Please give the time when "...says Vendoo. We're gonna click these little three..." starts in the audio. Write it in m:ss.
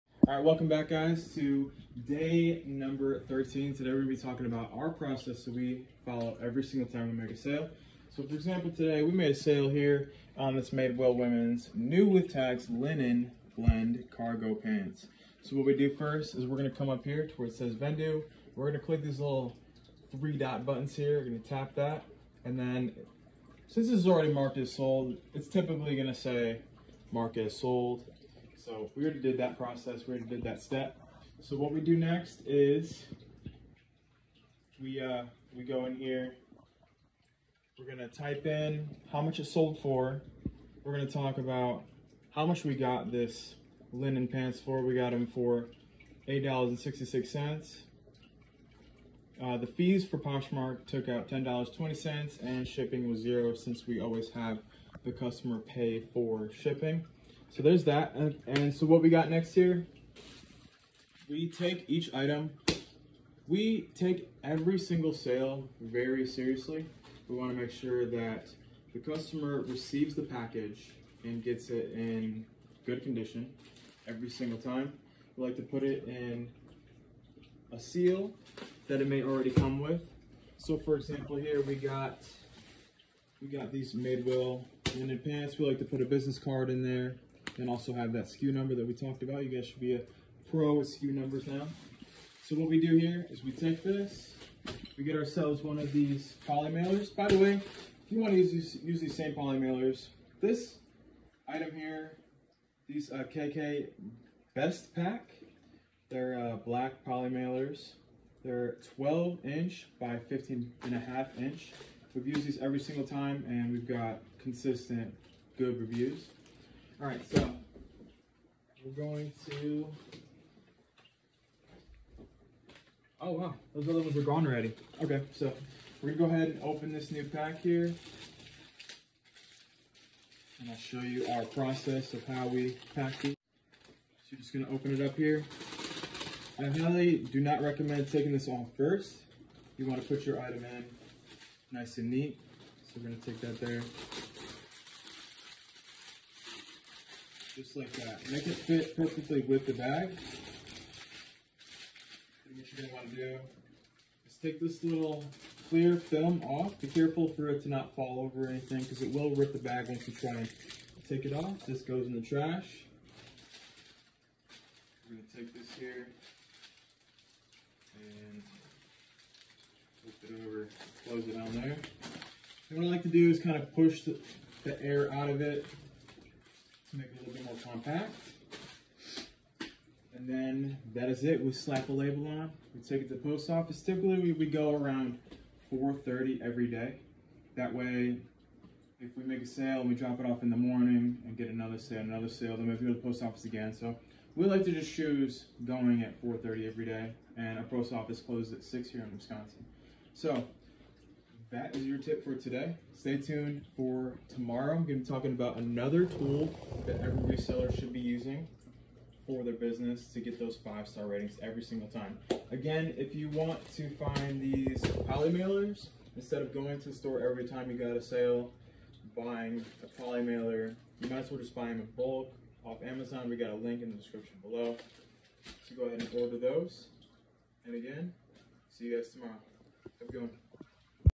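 0:17.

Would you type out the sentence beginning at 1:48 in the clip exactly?
They're 12 inch by 15 and a half inch.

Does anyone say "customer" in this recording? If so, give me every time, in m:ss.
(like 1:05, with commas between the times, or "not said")
0:55, 1:08.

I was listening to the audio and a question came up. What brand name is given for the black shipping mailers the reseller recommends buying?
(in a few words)
KK Best Pack.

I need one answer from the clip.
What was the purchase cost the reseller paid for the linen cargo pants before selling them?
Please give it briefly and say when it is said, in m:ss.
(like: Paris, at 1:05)
$8.66, at 0:46.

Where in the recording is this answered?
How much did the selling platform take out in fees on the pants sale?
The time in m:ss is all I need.
0:51.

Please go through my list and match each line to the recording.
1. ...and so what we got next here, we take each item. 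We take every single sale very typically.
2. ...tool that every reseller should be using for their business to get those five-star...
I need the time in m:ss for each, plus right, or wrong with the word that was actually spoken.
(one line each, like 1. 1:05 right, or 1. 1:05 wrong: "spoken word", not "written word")
1. 0:58 wrong: "seriously", not "typically"
2. 3:26 right.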